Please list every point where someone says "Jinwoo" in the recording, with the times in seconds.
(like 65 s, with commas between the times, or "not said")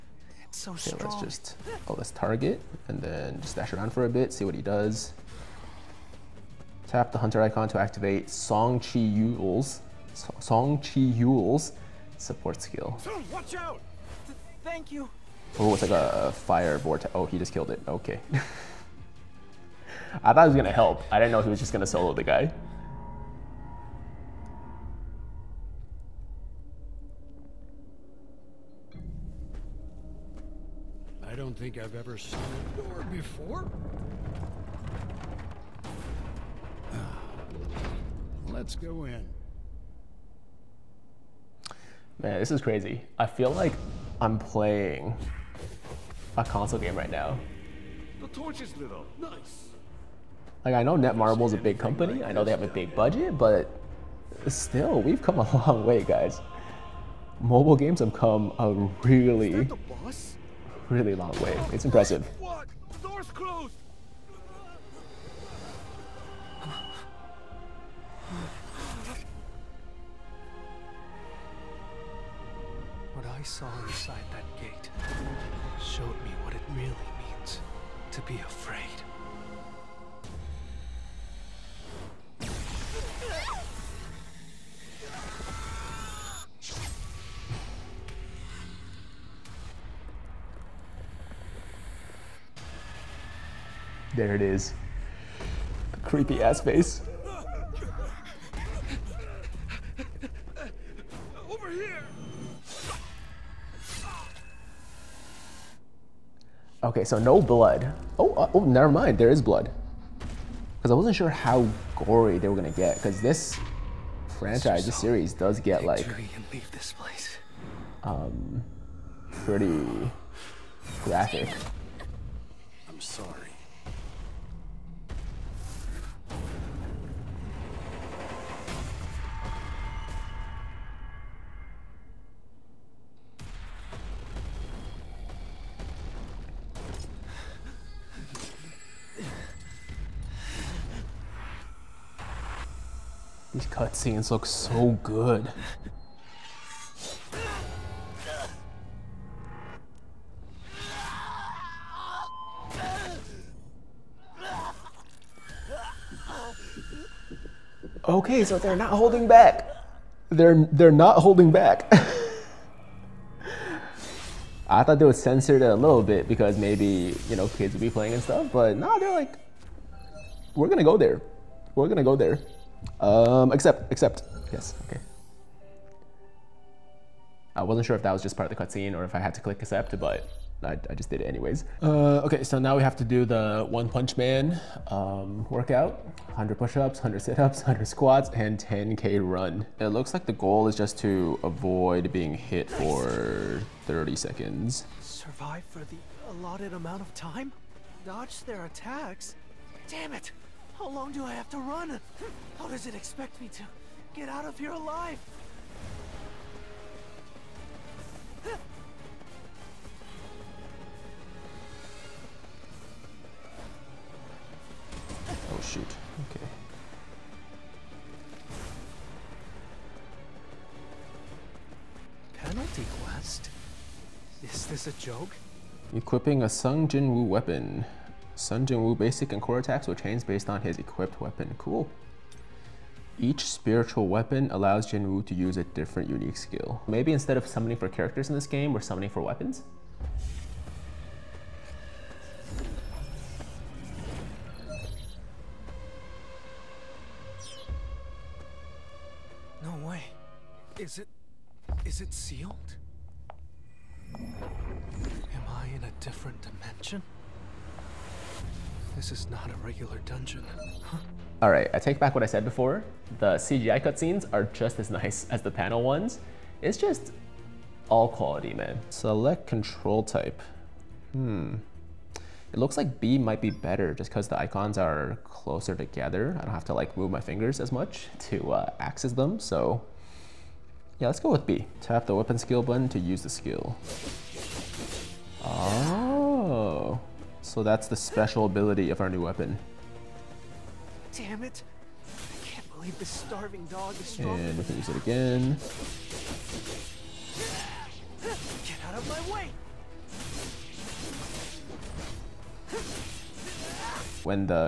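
228 s, 234 s.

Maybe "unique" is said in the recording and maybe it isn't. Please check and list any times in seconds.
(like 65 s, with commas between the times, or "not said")
236 s.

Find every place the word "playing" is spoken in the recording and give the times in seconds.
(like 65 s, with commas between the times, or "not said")
44 s, 167 s.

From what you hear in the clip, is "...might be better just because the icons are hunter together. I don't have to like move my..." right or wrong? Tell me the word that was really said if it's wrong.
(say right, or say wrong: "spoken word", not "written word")
wrong: "closer", not "hunter".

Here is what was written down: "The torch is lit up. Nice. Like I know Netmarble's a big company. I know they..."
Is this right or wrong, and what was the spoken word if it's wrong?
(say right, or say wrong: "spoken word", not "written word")
right.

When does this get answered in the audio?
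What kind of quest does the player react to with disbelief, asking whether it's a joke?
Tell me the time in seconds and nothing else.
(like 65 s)
222 s.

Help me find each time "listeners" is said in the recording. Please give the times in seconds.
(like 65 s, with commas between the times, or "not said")
not said.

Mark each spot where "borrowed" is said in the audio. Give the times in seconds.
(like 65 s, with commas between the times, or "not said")
not said.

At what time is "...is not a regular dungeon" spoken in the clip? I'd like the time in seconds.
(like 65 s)
259 s.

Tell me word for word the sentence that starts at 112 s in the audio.
Because this franchise, this series does get like um, pretty graphic.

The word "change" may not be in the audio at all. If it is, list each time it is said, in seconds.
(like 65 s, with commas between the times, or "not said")
229 s.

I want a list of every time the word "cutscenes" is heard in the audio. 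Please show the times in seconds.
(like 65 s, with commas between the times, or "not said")
143 s, 178 s, 263 s.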